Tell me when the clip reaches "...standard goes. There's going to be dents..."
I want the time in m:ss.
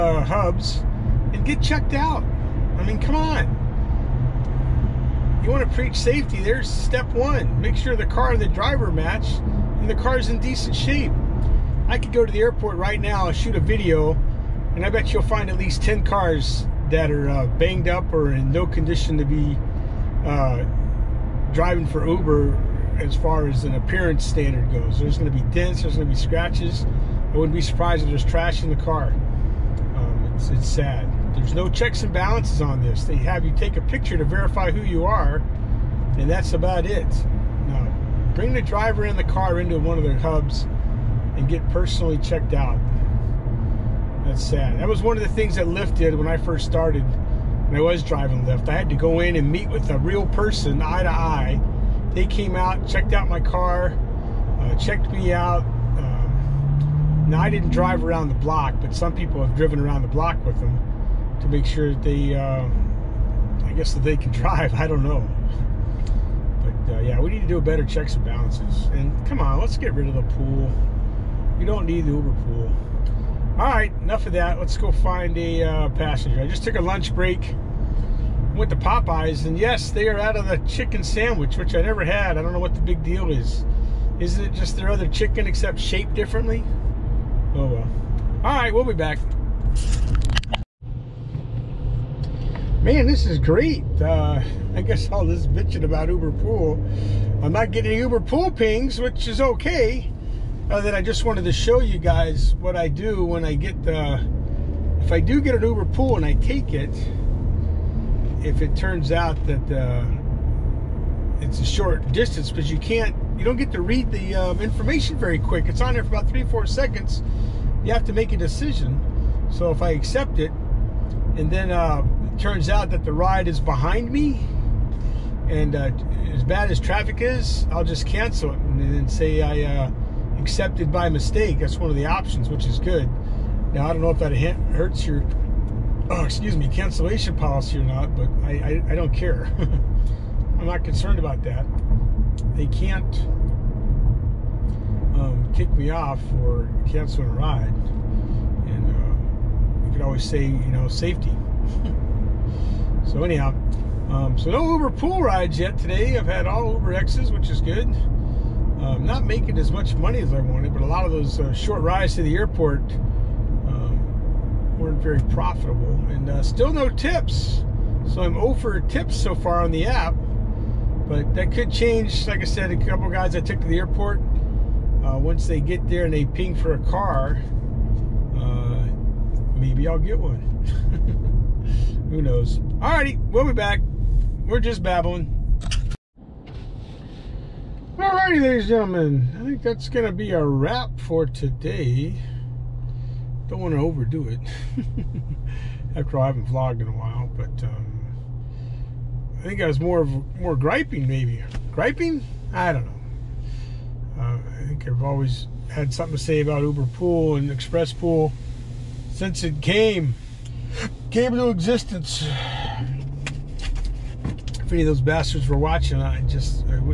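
0:24.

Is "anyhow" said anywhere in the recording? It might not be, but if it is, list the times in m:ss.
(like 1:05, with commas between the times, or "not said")
2:33.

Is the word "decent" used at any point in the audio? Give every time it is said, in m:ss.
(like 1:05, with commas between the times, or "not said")
0:10.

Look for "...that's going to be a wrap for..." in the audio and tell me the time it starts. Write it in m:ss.
3:09.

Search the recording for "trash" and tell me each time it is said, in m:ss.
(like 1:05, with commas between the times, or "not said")
0:28.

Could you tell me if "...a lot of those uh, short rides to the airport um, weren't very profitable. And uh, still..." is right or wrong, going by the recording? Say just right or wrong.
right.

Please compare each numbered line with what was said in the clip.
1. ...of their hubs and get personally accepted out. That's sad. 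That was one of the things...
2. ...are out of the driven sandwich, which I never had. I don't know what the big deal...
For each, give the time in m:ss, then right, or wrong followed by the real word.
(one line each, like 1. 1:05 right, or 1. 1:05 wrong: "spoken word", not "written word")
1. 0:39 wrong: "checked", not "accepted"
2. 1:20 wrong: "chicken", not "driven".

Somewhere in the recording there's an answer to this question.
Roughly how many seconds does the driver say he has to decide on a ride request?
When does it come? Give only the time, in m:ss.
1:56.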